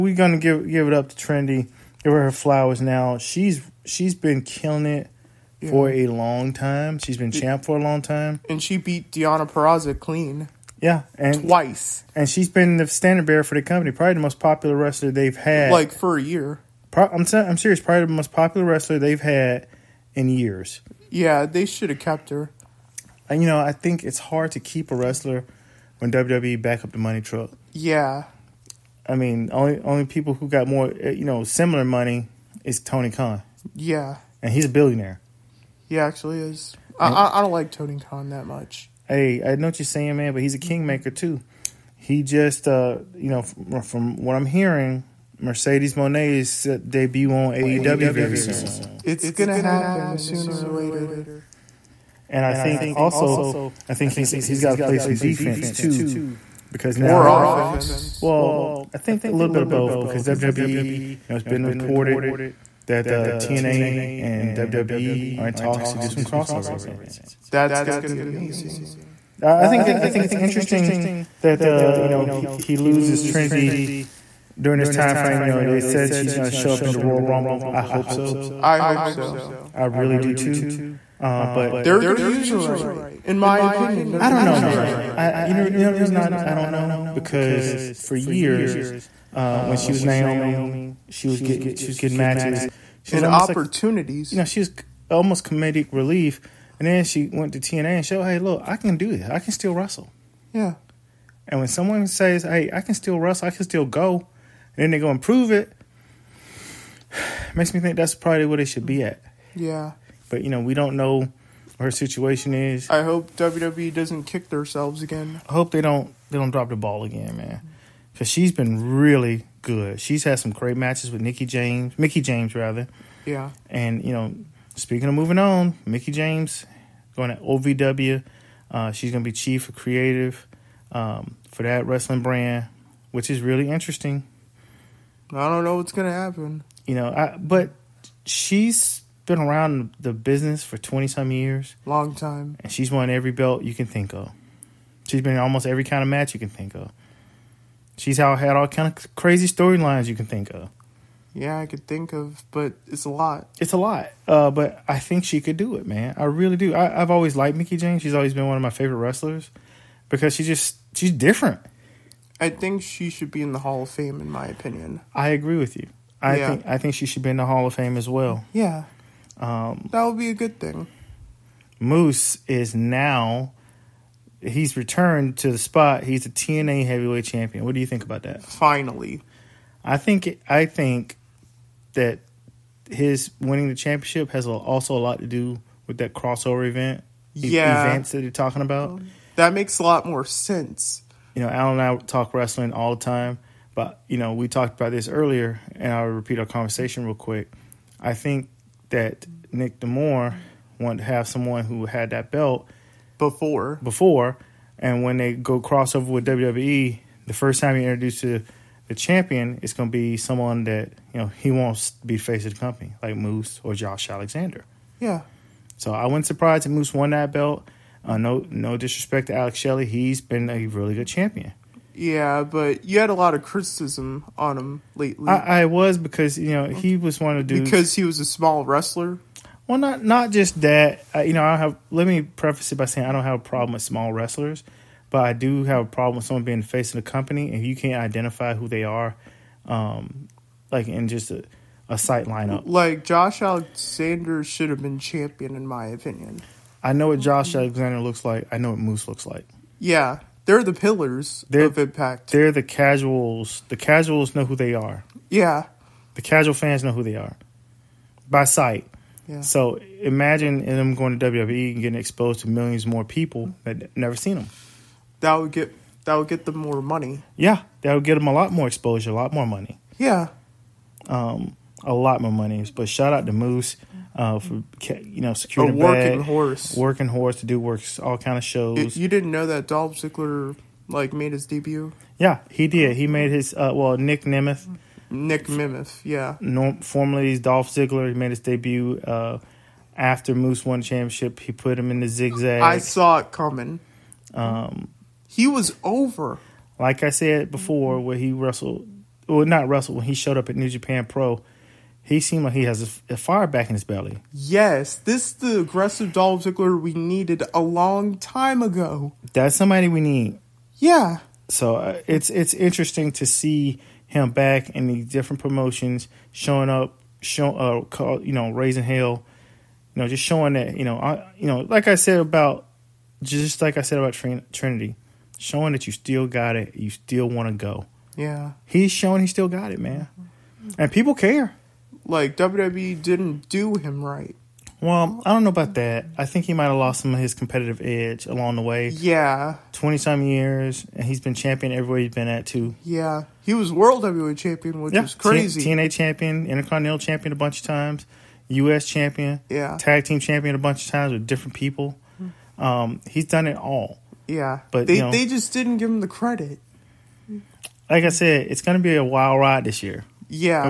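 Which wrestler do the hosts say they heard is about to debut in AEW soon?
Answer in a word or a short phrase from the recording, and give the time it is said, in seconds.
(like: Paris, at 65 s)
Mercedes Mone, at 45 s.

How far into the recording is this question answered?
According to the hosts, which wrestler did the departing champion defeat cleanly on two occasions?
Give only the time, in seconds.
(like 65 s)
9 s.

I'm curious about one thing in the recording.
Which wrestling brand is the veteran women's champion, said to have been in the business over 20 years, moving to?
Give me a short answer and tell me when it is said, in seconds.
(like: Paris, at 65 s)
OVW, at 127 s.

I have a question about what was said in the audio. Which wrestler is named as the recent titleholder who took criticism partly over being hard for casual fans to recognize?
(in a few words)
Alex Shelley.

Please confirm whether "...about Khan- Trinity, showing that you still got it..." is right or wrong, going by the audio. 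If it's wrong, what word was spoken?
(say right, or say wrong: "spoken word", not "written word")
wrong: "Trin", not "Khan".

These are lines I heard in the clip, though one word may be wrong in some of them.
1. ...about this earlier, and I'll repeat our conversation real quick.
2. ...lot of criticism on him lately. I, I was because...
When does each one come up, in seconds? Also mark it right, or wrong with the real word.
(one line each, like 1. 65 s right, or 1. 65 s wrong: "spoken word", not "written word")
1. 194 s right
2. 223 s right.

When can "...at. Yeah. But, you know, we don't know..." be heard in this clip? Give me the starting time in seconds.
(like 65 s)
109 s.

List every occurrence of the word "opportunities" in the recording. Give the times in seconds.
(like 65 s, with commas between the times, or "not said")
93 s.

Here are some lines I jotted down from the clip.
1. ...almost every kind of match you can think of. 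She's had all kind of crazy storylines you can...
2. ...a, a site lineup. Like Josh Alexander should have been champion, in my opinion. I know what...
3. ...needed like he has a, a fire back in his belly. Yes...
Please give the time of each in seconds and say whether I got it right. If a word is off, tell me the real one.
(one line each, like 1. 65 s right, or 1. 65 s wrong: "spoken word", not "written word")
1. 145 s right
2. 241 s right
3. 302 s wrong: "seemed", not "needed".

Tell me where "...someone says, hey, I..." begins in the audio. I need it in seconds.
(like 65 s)
101 s.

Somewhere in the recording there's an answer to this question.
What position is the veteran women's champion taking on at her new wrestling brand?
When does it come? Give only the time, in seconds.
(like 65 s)
129 s.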